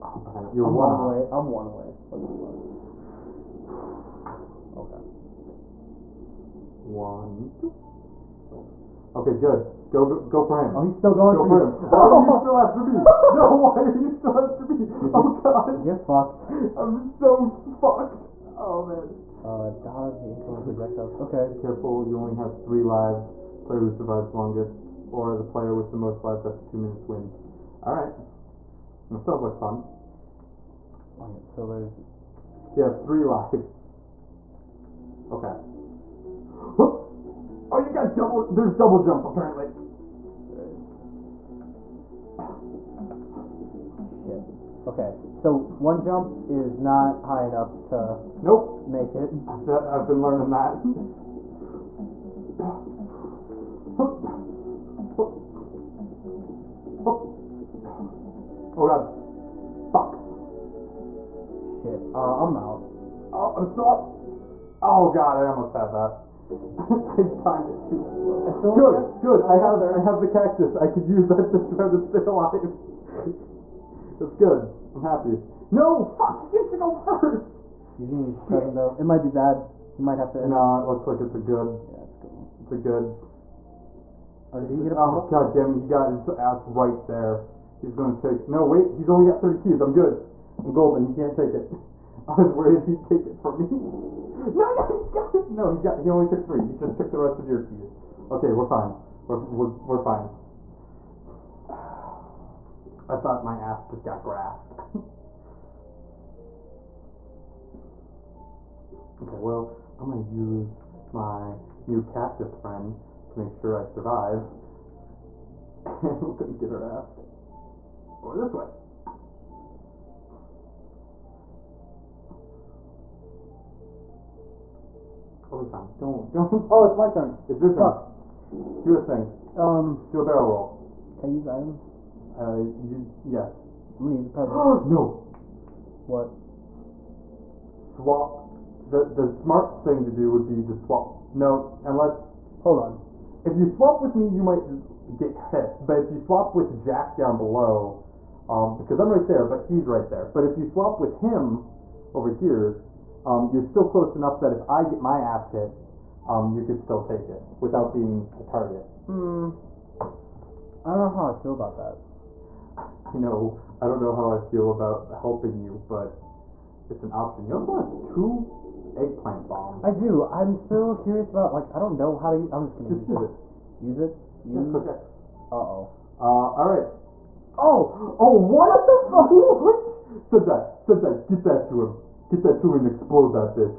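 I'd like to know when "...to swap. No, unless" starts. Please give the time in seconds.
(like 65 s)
140 s.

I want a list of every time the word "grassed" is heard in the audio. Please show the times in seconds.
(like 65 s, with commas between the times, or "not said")
104 s.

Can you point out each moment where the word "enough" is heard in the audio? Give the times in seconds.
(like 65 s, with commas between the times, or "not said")
47 s, 154 s.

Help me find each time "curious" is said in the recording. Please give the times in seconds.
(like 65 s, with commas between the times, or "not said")
170 s.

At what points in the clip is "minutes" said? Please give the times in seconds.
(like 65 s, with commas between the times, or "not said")
26 s.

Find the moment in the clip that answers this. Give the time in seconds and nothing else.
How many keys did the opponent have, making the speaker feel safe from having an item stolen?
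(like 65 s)
89 s.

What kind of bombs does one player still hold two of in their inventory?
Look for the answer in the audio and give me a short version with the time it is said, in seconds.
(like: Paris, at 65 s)
Eggplant bombs, at 168 s.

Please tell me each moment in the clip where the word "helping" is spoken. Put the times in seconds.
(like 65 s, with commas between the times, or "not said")
165 s.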